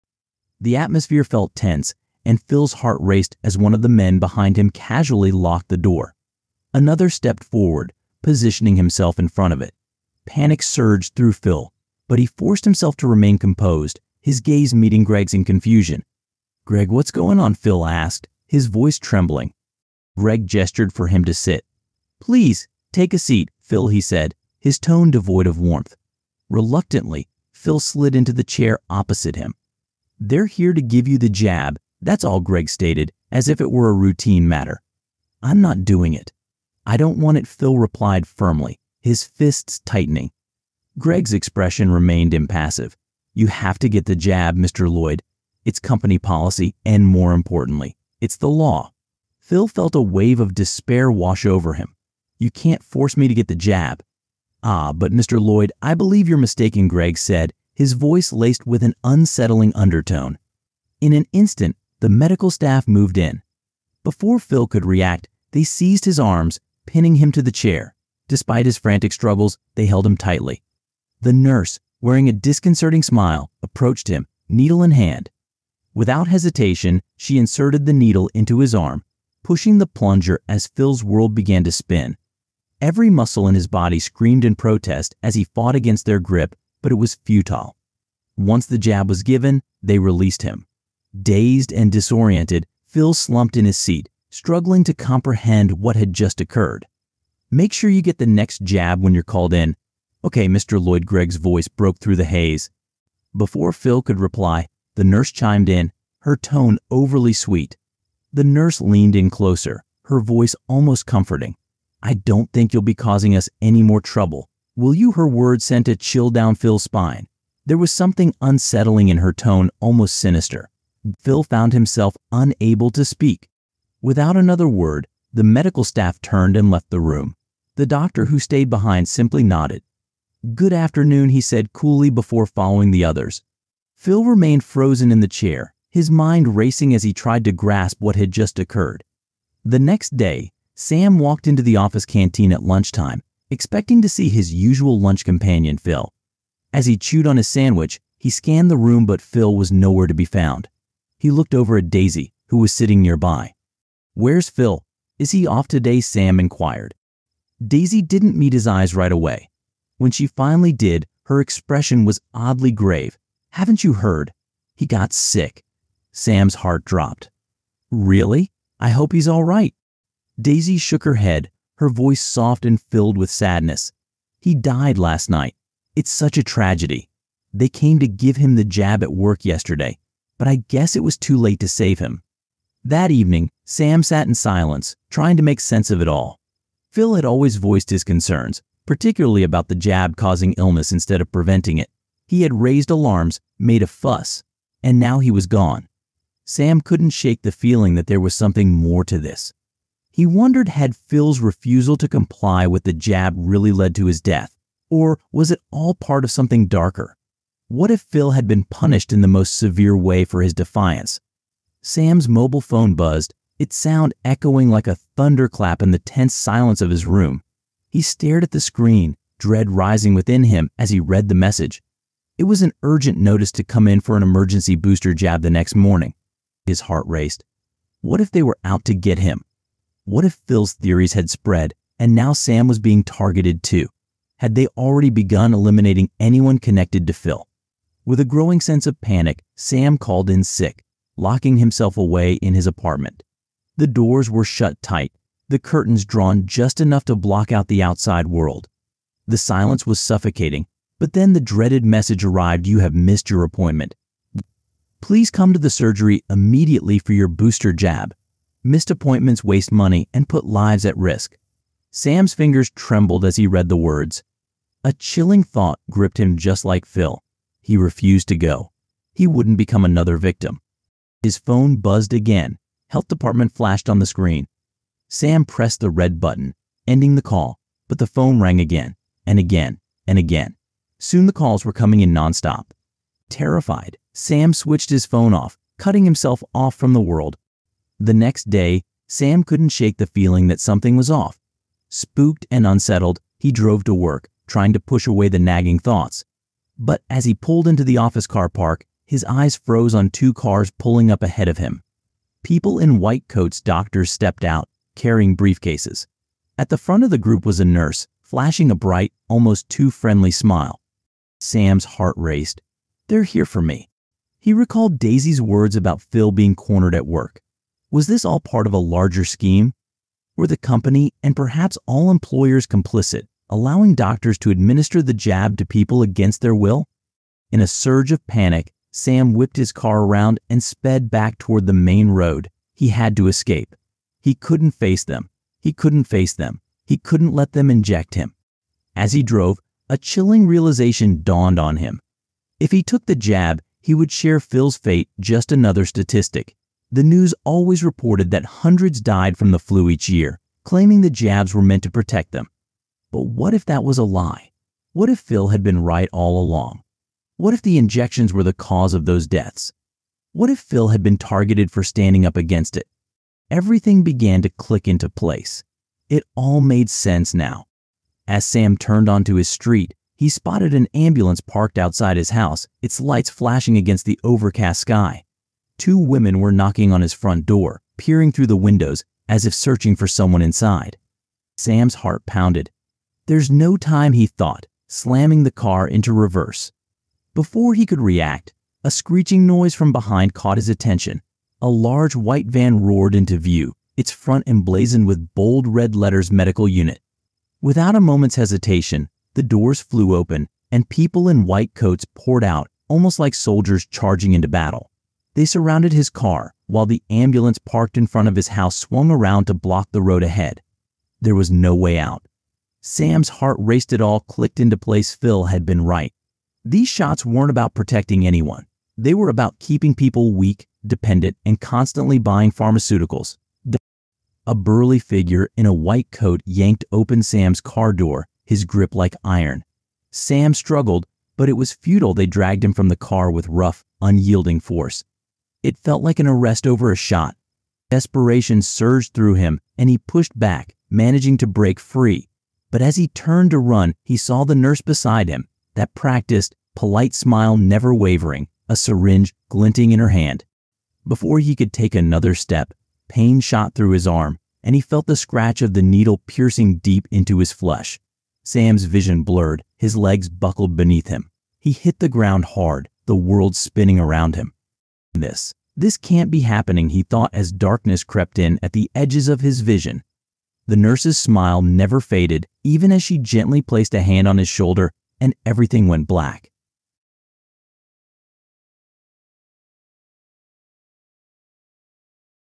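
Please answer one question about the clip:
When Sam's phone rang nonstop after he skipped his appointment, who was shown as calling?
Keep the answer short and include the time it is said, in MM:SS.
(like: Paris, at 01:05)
Health department, at 04:32.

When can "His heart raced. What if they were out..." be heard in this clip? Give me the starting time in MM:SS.
03:46.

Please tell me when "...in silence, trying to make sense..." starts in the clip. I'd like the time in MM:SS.
03:04.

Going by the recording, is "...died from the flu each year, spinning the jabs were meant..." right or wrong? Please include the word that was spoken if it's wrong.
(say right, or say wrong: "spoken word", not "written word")
wrong: "claiming", not "spinning".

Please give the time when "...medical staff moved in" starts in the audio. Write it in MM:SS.
01:02.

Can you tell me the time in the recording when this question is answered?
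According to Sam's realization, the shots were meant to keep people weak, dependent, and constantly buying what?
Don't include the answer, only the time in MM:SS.
07:02.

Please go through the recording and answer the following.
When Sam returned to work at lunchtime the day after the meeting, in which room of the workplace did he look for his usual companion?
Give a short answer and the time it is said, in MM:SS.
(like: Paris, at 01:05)
office canteen, at 02:21.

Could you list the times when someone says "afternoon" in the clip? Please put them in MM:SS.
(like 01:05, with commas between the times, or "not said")
02:10.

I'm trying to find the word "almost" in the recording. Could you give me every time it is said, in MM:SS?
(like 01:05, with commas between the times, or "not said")
01:50, 01:59, 05:09, 06:42.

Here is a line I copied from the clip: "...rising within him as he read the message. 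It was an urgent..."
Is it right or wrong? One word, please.
right.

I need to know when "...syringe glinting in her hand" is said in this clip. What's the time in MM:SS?
07:28.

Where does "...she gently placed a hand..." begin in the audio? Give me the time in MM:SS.
07:53.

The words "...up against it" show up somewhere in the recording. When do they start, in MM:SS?
06:02.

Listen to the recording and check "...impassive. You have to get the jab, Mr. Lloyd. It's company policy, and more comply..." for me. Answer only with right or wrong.
wrong.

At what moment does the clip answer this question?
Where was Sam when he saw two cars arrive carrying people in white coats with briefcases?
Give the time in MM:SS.
04:57.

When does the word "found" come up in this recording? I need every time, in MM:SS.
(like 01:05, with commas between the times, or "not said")
02:01, 02:30.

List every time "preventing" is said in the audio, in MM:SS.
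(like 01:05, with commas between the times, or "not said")
03:11.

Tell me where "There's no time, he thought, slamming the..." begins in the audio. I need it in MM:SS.
06:23.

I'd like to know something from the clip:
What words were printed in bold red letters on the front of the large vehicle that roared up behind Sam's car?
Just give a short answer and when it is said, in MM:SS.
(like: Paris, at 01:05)
Medical Unit, at 06:36.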